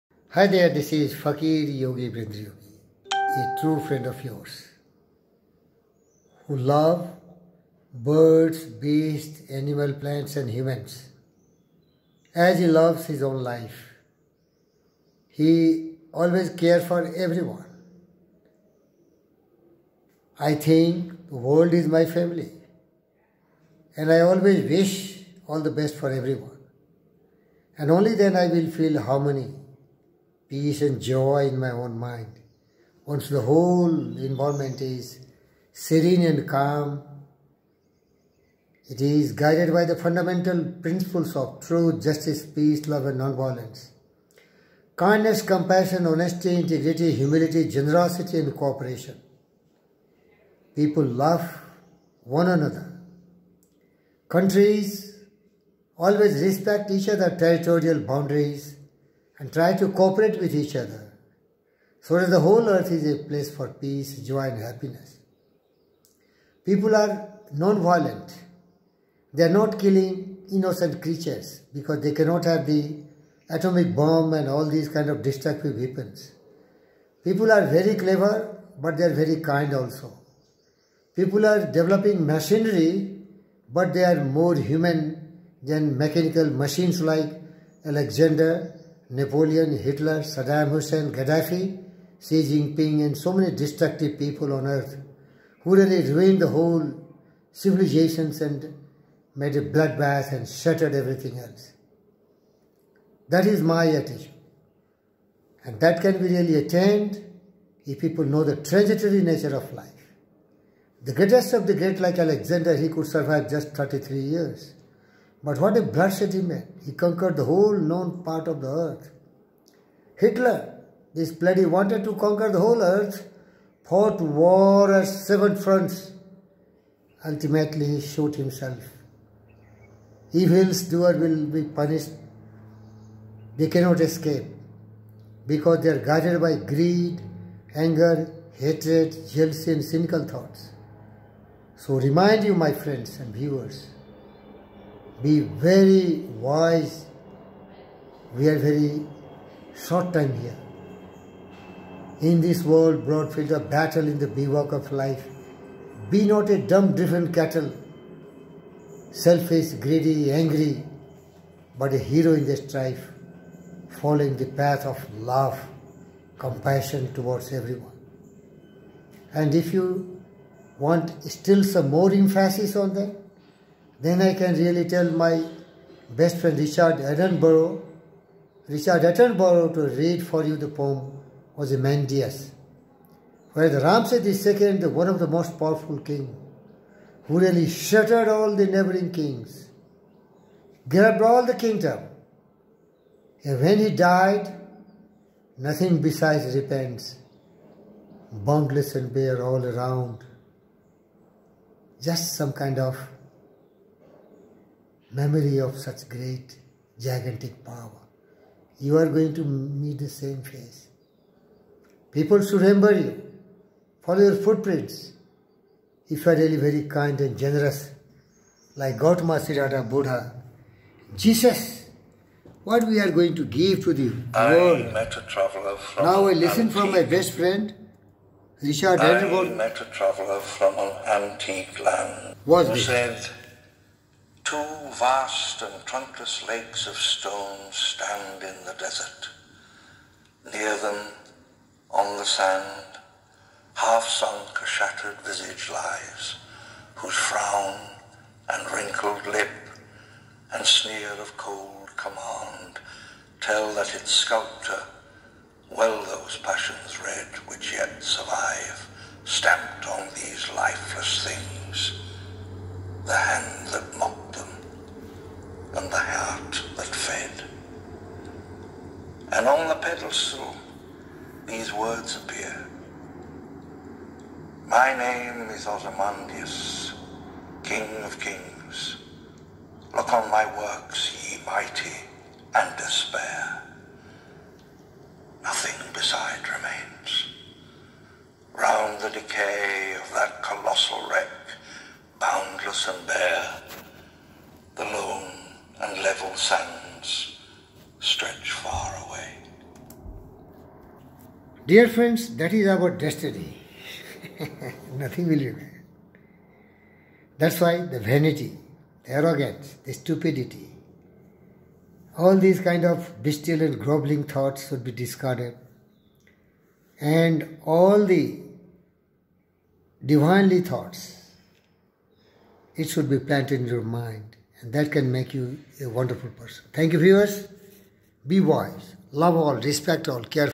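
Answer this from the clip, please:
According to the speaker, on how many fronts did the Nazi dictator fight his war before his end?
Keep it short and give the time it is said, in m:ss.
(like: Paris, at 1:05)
7, at 2:05.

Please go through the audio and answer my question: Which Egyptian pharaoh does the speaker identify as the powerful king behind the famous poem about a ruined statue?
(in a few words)
Ramses II.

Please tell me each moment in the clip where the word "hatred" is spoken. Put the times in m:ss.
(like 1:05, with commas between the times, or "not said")
2:18.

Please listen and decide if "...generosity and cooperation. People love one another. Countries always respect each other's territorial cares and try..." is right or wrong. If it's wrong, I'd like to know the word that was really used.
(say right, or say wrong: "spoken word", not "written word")
wrong: "boundaries", not "cares".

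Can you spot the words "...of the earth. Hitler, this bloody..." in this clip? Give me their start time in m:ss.
1:58.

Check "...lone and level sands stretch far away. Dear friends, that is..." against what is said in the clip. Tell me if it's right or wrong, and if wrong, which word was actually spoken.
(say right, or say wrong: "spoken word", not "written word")
right.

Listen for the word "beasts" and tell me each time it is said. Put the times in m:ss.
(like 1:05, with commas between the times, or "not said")
0:08.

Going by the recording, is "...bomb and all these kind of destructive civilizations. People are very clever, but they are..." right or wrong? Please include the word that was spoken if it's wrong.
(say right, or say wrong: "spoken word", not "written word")
wrong: "weapons", not "civilizations".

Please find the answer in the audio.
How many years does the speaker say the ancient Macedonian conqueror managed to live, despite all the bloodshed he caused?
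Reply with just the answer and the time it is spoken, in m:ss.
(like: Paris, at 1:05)
33, at 1:53.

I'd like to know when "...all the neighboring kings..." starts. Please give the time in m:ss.
3:08.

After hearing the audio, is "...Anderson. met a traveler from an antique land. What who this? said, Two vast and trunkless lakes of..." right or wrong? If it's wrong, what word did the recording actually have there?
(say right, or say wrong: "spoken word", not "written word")
right.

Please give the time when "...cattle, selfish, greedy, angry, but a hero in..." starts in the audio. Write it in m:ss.
2:37.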